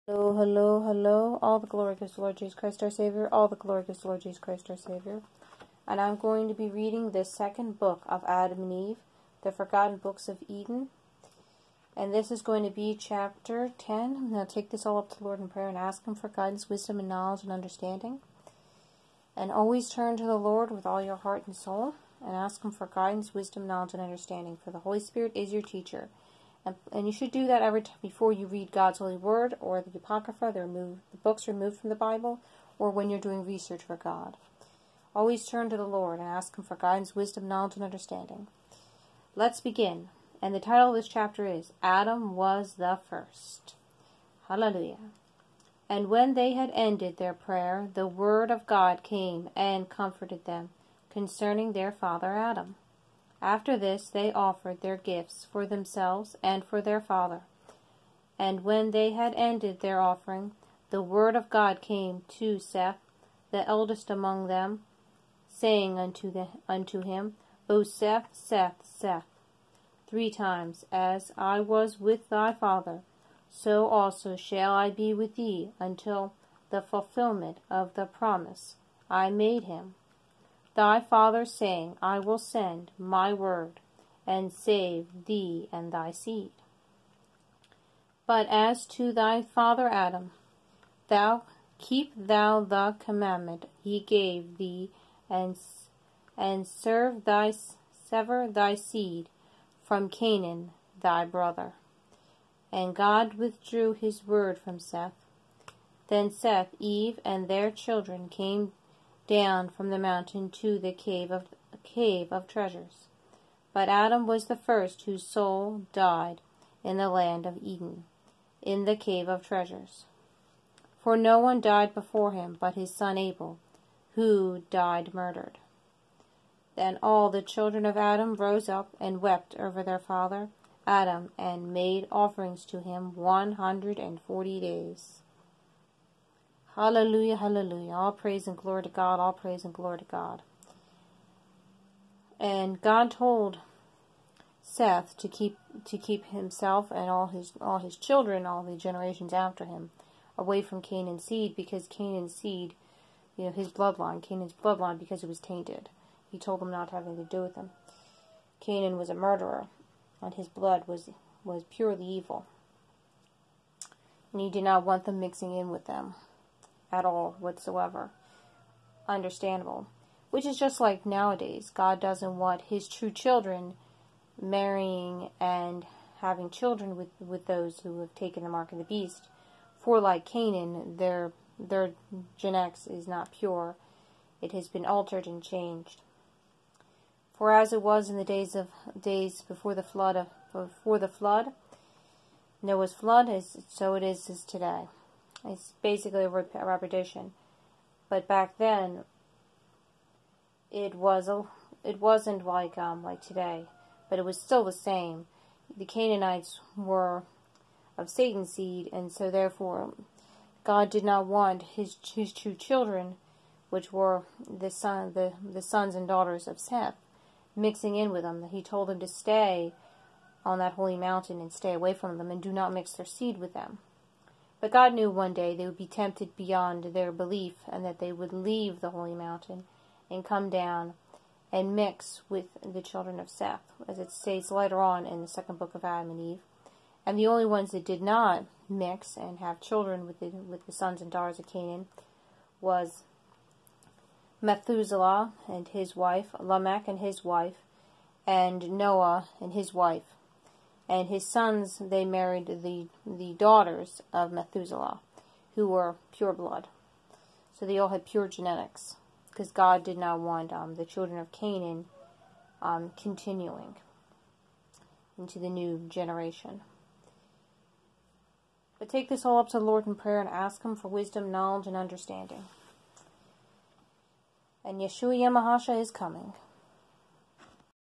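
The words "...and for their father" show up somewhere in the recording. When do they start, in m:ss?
0:56.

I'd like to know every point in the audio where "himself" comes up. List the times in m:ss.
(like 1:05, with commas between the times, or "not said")
2:26.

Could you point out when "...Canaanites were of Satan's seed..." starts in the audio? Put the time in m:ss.
3:25.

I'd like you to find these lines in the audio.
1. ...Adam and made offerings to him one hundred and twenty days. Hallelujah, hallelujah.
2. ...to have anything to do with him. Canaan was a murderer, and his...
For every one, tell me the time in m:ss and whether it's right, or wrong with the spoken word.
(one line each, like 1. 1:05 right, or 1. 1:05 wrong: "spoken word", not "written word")
1. 2:10 wrong: "forty", not "twenty"
2. 2:36 right.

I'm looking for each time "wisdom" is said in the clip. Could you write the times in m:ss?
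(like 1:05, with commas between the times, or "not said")
0:16, 0:23, 0:37, 4:30.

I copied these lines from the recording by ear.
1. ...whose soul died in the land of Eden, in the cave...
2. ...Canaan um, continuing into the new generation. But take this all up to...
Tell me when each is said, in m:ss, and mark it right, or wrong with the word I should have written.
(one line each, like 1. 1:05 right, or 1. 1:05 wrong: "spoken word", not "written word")
1. 1:55 right
2. 4:21 right.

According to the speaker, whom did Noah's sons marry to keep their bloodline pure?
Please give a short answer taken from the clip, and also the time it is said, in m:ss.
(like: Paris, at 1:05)
Daughters of Methuselah, at 4:13.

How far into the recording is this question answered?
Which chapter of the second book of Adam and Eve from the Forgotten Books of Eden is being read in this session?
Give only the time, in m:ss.
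0:12.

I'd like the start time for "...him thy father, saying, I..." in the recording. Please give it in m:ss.
1:19.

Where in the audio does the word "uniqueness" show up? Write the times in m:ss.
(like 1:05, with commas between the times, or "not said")
not said.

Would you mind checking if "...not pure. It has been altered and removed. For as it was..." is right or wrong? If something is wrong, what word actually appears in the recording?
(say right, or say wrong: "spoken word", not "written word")
wrong: "changed", not "removed".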